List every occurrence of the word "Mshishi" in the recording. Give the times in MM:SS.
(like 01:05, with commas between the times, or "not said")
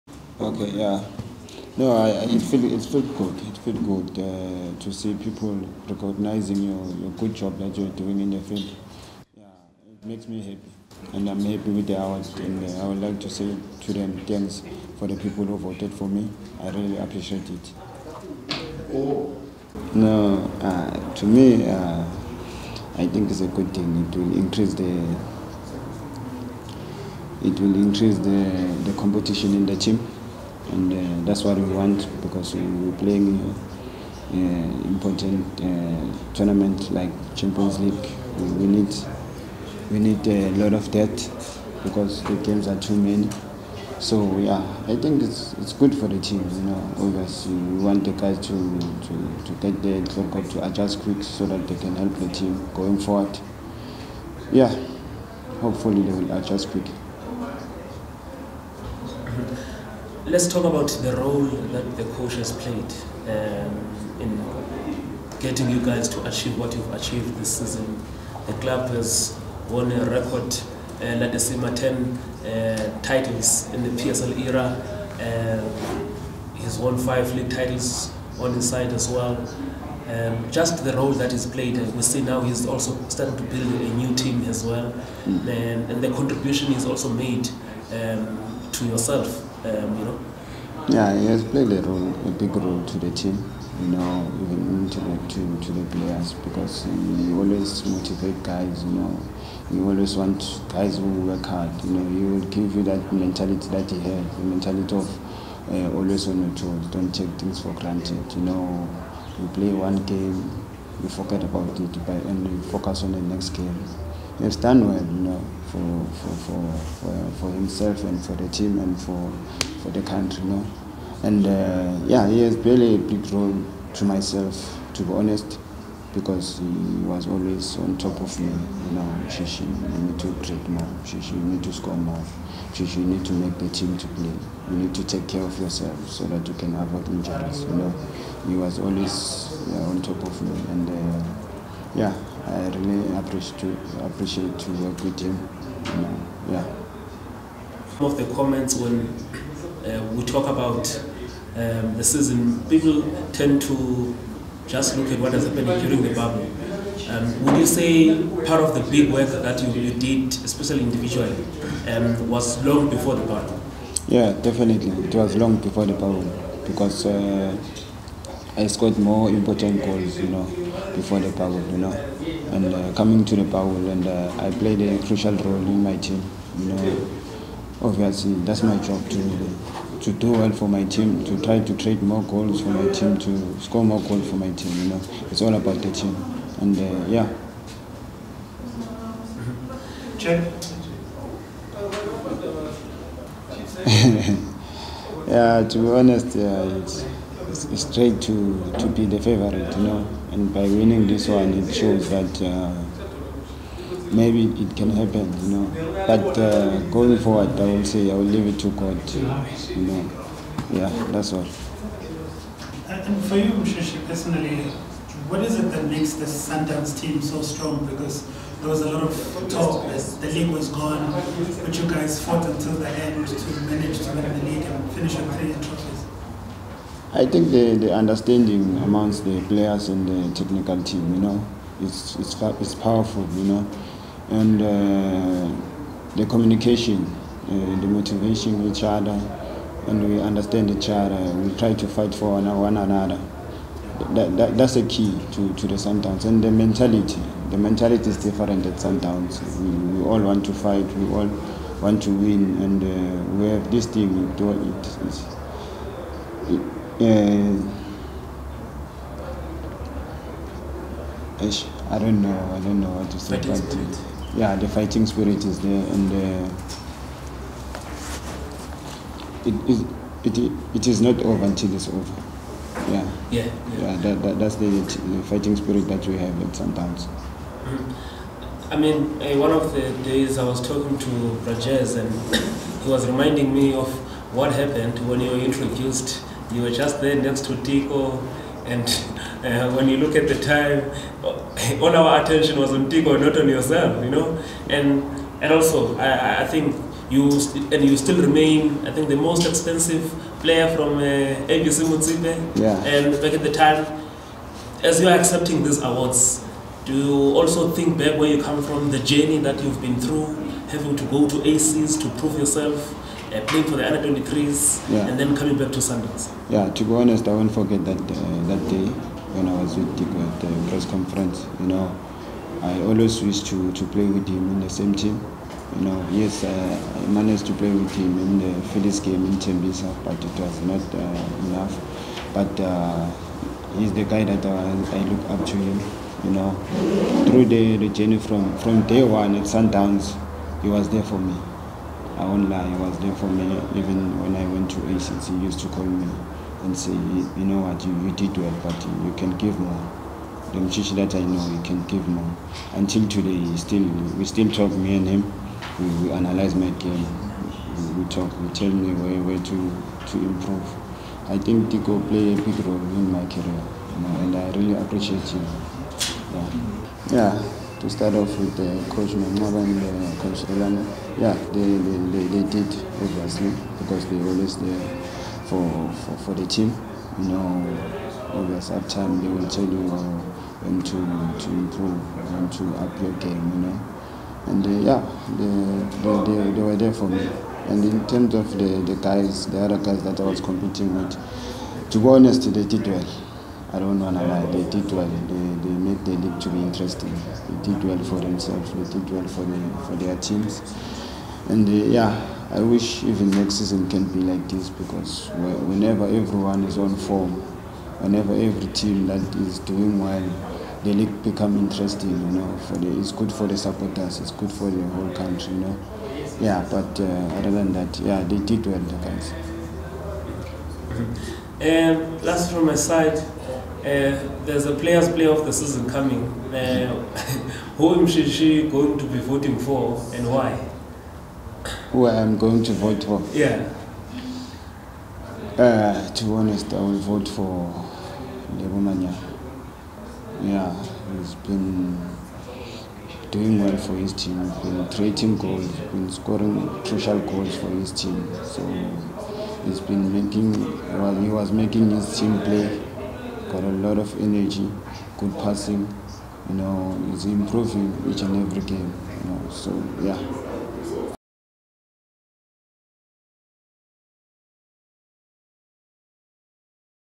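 03:33, 07:07.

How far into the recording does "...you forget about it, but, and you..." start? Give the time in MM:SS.
01:51.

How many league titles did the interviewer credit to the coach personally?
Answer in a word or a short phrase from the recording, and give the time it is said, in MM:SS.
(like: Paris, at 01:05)
5, at 01:16.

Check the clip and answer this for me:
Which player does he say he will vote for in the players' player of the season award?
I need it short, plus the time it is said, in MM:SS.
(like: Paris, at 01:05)
Lebo Manyama, at 07:18.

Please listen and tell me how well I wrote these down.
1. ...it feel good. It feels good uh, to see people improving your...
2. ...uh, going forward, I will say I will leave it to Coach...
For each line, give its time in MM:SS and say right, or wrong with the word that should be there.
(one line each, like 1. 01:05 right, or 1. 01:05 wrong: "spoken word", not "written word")
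1. 00:02 wrong: "recognizing", not "improving"
2. 03:26 wrong: "God", not "Coach".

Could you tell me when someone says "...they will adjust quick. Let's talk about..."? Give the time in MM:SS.
00:56.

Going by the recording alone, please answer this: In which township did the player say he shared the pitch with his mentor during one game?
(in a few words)
Tembisa.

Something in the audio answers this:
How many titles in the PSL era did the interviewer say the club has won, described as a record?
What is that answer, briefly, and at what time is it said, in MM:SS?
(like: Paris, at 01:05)
10, at 01:11.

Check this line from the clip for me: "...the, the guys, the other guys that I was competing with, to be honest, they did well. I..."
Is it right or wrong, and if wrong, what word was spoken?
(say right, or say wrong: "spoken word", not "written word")
right.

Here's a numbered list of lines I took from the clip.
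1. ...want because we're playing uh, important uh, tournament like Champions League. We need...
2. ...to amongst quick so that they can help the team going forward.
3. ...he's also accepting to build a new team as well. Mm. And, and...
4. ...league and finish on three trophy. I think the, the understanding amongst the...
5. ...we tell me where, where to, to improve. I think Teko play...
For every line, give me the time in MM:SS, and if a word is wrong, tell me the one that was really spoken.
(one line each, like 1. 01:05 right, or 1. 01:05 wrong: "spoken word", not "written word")
1. 00:31 right
2. 00:50 wrong: "adjust", not "amongst"
3. 01:22 wrong: "starting", not "accepting"
4. 03:44 right
5. 05:58 right.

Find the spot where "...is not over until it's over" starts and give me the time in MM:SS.
04:30.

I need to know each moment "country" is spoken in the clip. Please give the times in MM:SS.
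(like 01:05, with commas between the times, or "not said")
02:00, 06:55.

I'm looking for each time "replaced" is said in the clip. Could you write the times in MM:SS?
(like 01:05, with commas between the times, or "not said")
not said.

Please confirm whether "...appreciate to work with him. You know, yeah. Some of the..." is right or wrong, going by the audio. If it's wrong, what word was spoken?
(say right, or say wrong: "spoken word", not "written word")
right.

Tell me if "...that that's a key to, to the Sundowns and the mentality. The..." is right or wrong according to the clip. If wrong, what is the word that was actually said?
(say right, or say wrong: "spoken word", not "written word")
right.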